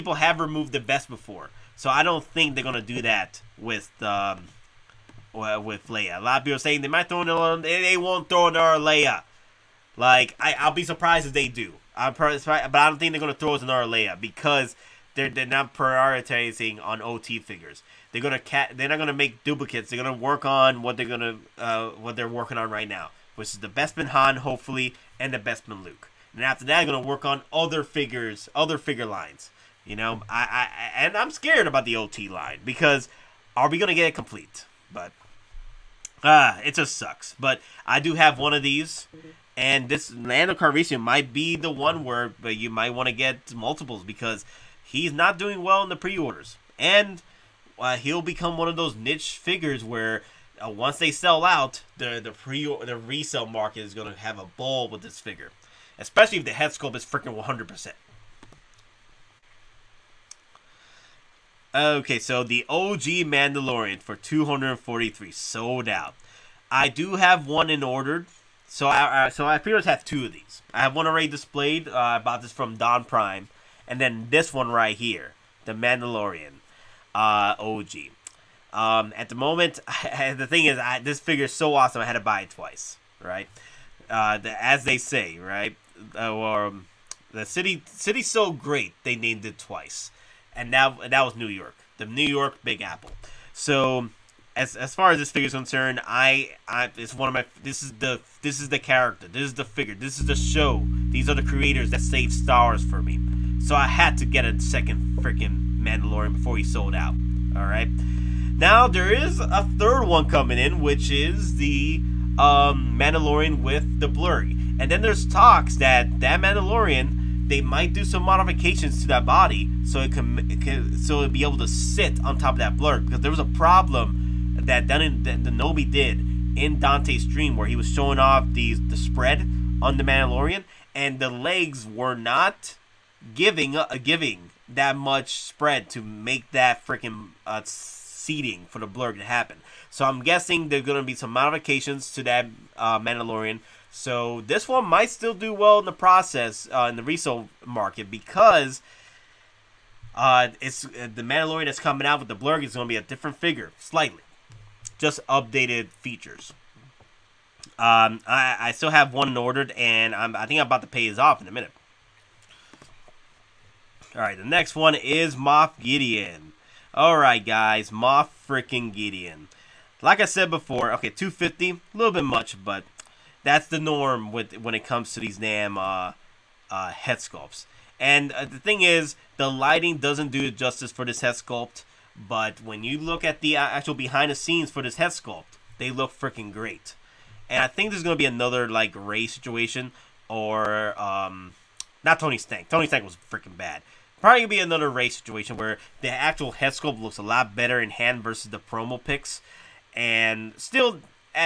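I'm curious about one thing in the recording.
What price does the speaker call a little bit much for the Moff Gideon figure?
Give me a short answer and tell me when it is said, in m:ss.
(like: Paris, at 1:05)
250, at 2:51.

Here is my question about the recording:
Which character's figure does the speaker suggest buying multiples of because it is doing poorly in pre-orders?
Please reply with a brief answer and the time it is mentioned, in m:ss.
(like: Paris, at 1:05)
Lando Calrissian, at 0:40.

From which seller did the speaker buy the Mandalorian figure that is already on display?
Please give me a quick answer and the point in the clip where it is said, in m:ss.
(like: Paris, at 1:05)
Don Prime, at 1:12.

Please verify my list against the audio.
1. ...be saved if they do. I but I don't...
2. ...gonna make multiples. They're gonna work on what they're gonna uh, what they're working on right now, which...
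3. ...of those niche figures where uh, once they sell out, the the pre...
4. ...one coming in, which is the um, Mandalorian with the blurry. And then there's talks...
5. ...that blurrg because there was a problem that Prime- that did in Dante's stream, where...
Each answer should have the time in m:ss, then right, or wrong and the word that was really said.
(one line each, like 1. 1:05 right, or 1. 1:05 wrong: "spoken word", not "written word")
1. 0:10 wrong: "surprised", not "saved"
2. 0:18 wrong: "duplicates", not "multiples"
3. 0:48 right
4. 1:50 right
5. 2:02 wrong: "Dun", not "Prime".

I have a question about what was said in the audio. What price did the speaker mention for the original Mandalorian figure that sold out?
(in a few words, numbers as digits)
243.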